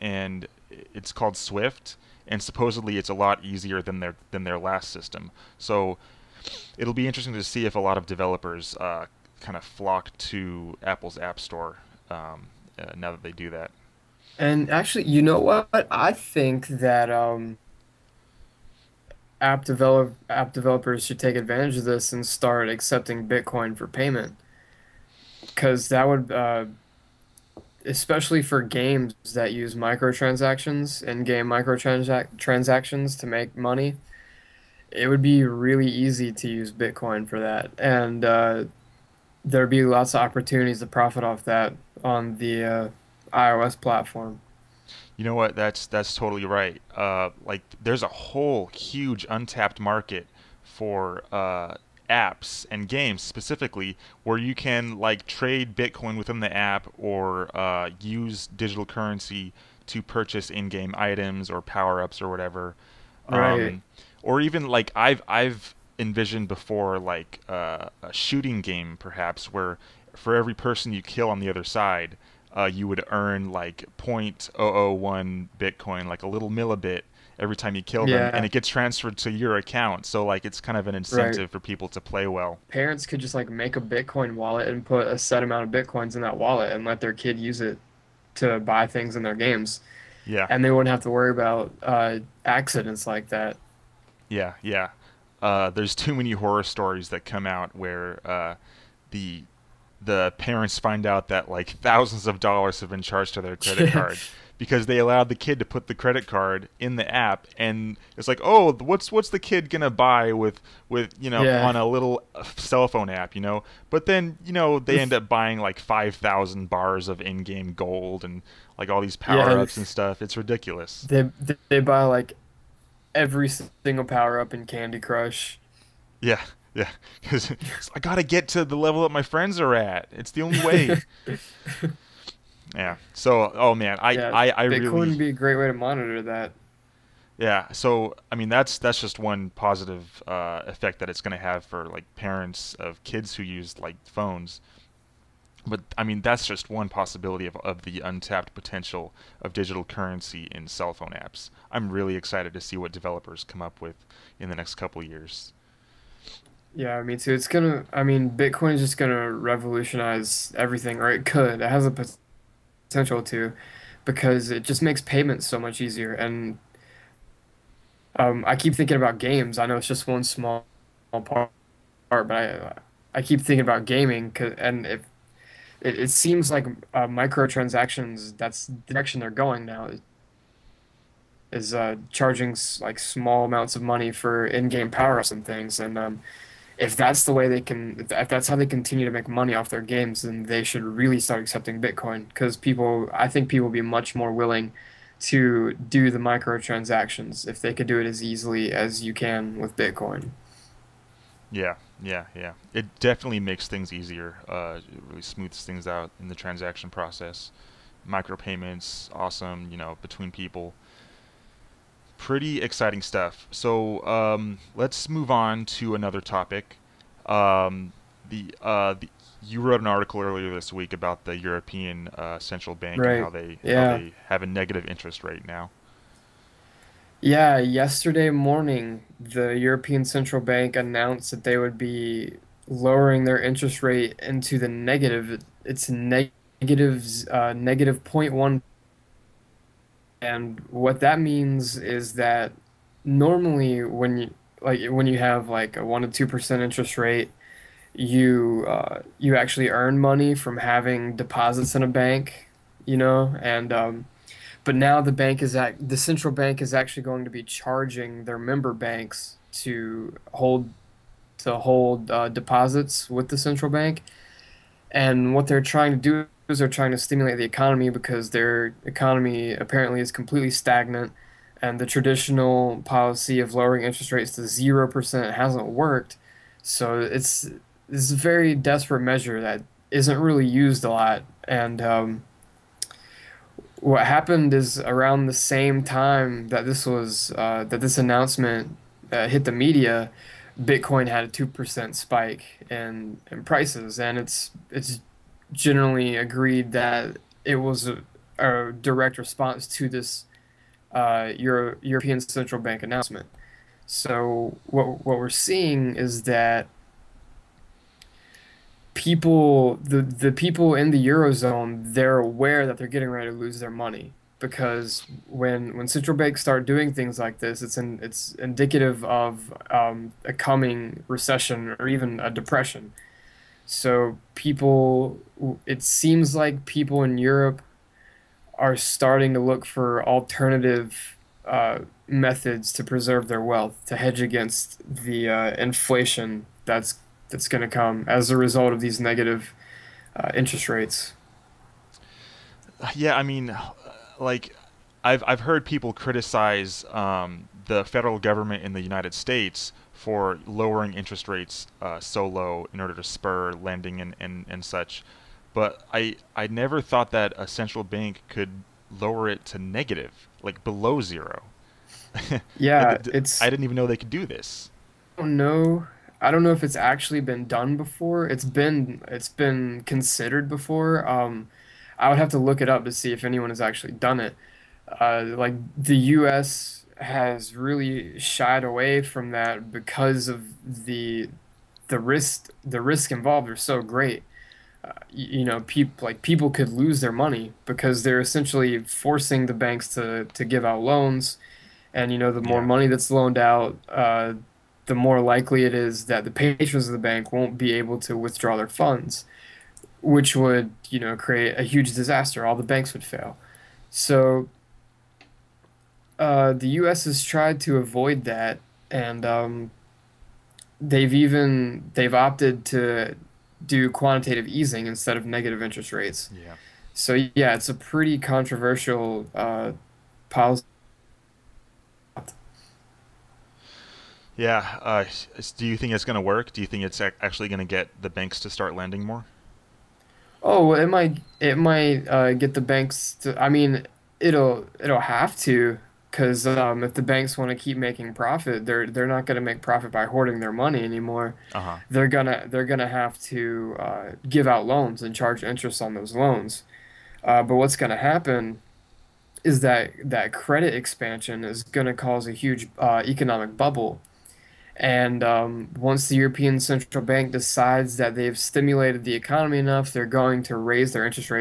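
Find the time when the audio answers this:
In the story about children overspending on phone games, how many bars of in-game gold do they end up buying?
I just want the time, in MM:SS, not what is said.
01:55.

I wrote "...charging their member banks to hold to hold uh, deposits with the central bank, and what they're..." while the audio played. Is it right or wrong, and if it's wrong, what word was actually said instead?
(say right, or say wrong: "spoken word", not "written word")
right.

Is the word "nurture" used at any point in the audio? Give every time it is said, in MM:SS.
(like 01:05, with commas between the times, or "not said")
not said.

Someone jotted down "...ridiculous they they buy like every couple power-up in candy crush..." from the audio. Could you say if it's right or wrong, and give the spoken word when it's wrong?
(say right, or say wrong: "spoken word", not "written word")
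wrong: "single", not "couple".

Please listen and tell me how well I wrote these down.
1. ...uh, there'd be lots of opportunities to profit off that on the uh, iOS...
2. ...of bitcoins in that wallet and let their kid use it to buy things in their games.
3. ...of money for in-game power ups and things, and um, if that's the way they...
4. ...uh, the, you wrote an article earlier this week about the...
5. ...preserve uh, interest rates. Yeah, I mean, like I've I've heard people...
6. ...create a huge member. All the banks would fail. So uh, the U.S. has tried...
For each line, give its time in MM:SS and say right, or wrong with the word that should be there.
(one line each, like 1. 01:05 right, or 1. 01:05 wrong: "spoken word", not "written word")
1. 00:38 right
2. 01:25 right
3. 03:03 right
4. 03:38 right
5. 05:38 wrong: "negative", not "preserve"
6. 06:41 wrong: "disaster", not "member".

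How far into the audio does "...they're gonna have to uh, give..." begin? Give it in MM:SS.
07:22.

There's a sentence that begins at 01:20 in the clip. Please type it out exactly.
So like it's kind of an incentive right.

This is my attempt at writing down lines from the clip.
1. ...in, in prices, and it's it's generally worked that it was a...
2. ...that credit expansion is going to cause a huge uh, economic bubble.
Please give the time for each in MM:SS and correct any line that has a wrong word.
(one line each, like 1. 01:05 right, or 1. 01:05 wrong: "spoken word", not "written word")
1. 04:52 wrong: "agreed", not "worked"
2. 07:30 right.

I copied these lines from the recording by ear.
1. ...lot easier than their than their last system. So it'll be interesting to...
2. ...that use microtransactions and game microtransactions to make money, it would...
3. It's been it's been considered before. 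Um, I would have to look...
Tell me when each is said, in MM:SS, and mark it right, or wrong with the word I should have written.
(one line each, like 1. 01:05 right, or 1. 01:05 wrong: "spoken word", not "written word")
1. 00:03 right
2. 00:29 right
3. 06:08 right.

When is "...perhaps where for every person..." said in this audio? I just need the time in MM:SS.
01:08.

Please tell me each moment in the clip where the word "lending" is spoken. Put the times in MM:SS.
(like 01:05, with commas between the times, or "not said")
05:53, 07:08.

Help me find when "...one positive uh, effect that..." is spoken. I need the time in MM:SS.
02:19.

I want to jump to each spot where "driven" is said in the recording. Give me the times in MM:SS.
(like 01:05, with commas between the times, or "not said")
not said.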